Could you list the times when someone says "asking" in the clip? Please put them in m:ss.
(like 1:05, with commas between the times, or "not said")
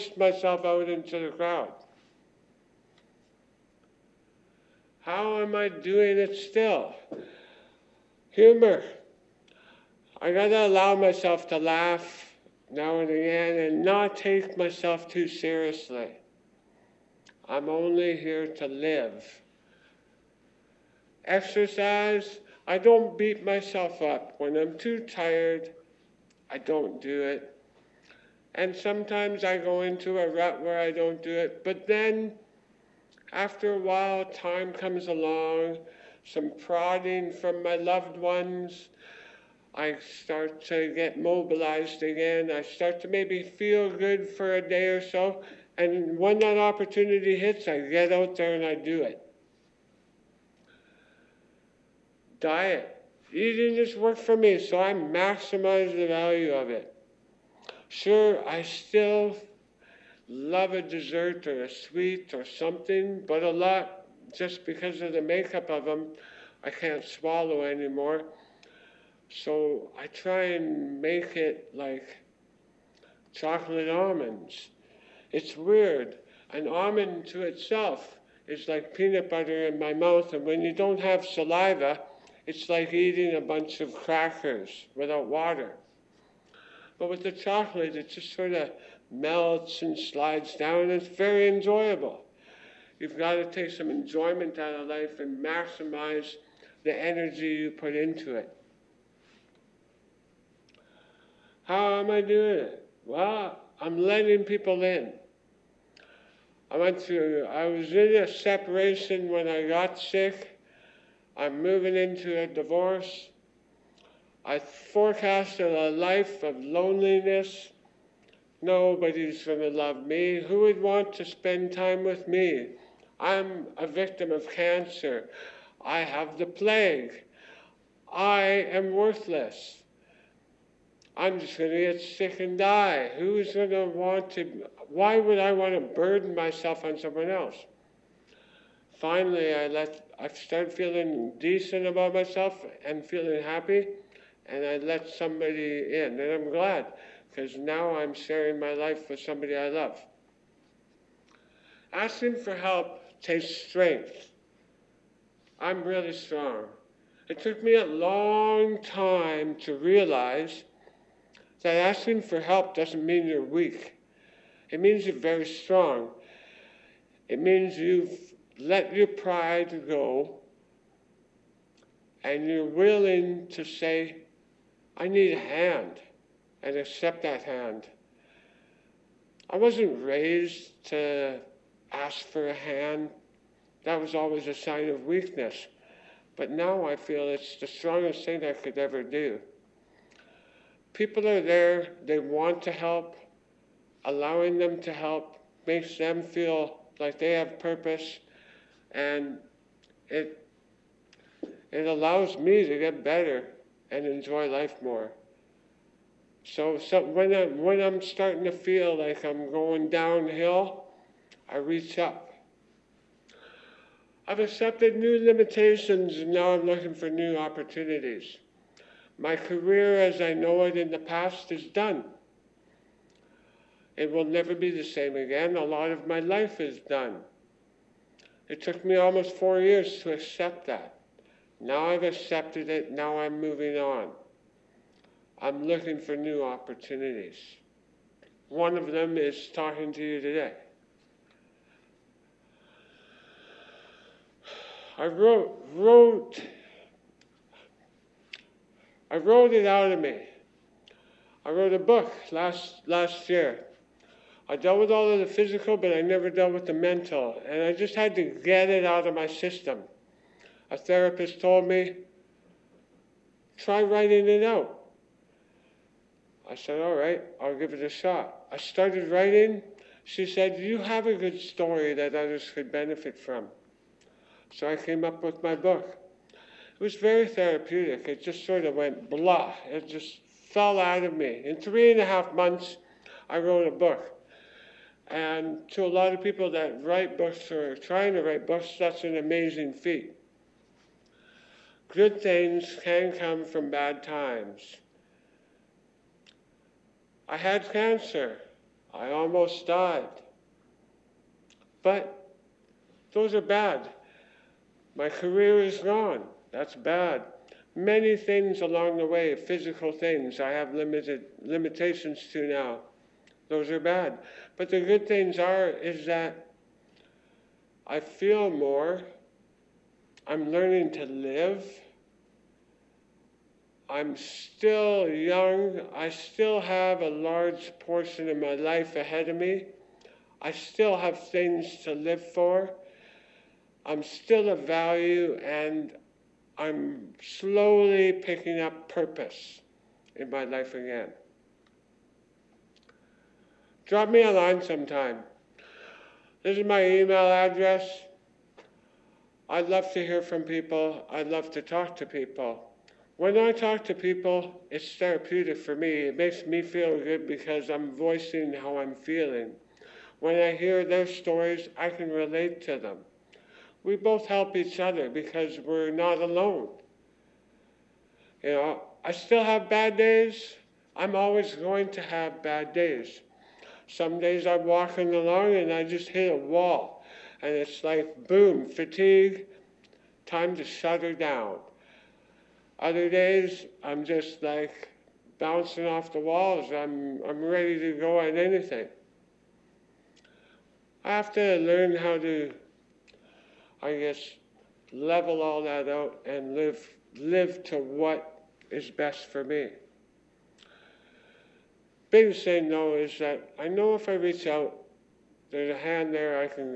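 2:31, 2:41.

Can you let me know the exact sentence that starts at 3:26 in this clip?
So, so when I when I'm starting to feel like I'm going downhill, I reach up.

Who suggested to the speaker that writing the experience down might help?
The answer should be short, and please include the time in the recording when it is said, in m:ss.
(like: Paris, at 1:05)
a therapist, at 4:20.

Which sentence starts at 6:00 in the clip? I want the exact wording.
When I hear their stories, I can relate to them we both help each other because we're not alone.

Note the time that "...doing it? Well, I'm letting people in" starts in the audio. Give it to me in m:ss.
1:42.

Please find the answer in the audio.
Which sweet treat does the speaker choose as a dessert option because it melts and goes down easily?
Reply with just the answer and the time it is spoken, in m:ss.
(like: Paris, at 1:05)
chocolate almonds, at 1:13.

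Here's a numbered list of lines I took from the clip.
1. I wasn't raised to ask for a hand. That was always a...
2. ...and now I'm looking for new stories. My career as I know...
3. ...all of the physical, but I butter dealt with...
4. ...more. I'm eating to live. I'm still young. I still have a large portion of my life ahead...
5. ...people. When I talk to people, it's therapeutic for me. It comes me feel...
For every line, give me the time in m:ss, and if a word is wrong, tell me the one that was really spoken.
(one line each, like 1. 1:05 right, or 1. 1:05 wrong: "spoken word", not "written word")
1. 2:59 right
2. 3:36 wrong: "opportunities", not "stories"
3. 4:14 wrong: "never", not "butter"
4. 5:18 wrong: "learning", not "eating"
5. 5:52 wrong: "makes", not "comes".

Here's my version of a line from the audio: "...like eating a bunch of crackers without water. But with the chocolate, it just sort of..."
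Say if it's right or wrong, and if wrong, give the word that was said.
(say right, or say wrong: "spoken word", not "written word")
right.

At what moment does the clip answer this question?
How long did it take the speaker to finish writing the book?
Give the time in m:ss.
4:41.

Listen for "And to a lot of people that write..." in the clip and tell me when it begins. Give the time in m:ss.
4:45.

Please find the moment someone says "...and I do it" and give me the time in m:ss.
0:48.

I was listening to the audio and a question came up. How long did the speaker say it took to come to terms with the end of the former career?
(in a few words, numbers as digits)
almost 4 years.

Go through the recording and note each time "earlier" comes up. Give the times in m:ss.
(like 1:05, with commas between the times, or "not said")
not said.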